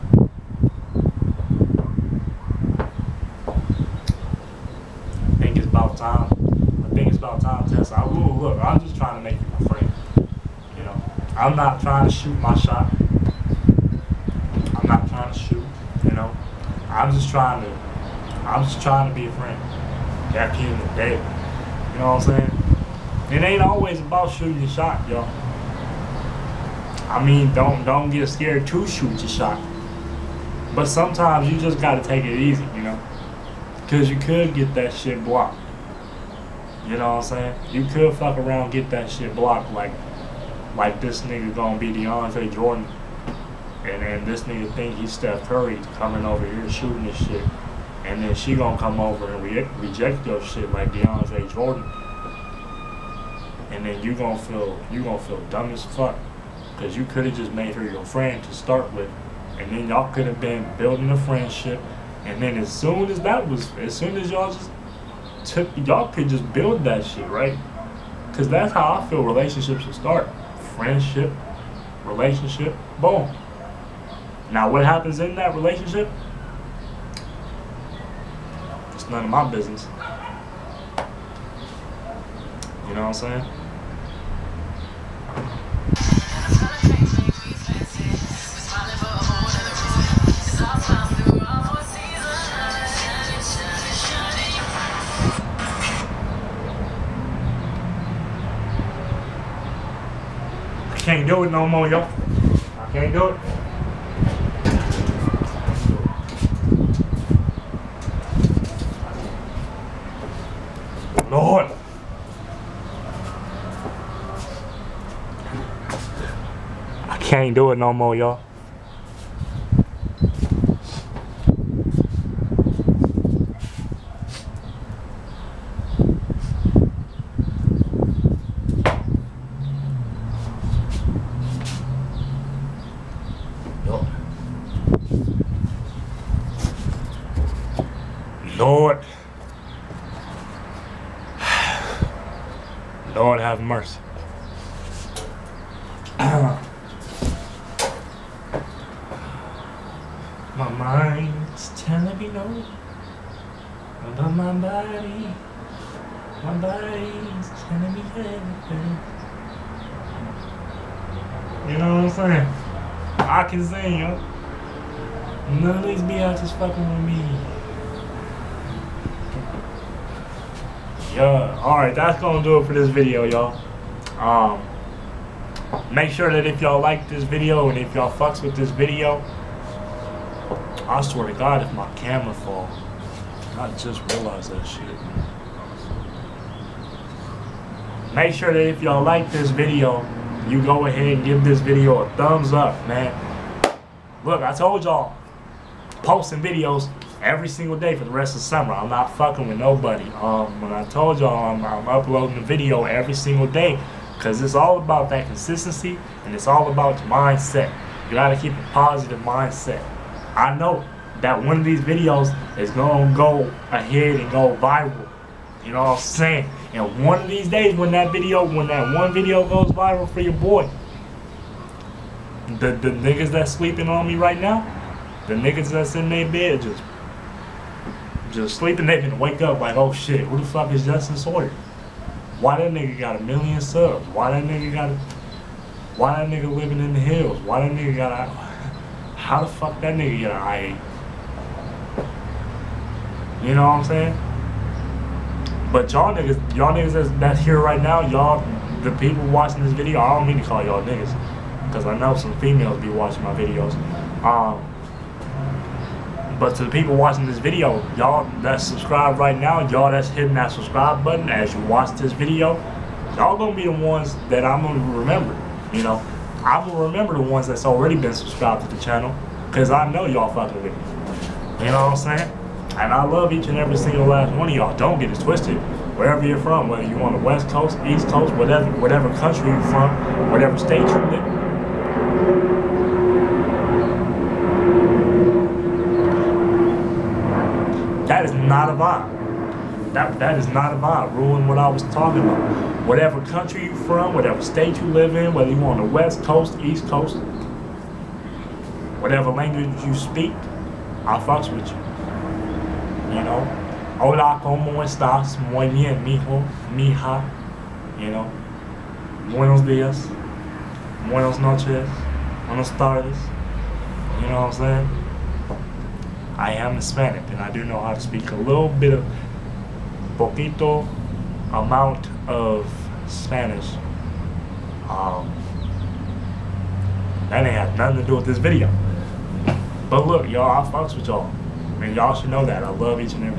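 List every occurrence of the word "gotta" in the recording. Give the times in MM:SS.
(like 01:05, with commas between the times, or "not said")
00:31, 03:28.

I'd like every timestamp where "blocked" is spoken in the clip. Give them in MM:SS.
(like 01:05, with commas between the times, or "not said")
00:35, 00:39.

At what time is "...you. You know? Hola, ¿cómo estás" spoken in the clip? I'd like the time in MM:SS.
05:01.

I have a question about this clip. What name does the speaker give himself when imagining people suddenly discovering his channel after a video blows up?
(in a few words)
Jesten Sawyer.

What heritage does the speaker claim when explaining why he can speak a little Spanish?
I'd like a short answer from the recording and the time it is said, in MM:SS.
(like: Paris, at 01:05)
Hispanic, at 05:16.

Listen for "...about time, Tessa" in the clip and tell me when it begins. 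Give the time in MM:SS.
00:07.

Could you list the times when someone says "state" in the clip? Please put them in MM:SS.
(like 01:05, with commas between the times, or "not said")
04:40, 04:54.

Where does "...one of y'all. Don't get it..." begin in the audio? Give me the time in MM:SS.
04:34.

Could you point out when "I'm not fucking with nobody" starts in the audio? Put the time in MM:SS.
03:18.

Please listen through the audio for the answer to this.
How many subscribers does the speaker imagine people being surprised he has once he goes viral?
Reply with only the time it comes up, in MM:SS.
03:53.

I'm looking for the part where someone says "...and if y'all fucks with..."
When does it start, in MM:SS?
02:57.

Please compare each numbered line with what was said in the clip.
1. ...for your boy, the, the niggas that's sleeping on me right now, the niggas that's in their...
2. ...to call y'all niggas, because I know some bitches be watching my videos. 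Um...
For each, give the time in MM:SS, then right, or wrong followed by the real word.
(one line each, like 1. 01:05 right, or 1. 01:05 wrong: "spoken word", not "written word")
1. 03:40 right
2. 04:10 wrong: "females", not "bitches".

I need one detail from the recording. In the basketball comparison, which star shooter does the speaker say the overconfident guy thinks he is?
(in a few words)
Steph Curry.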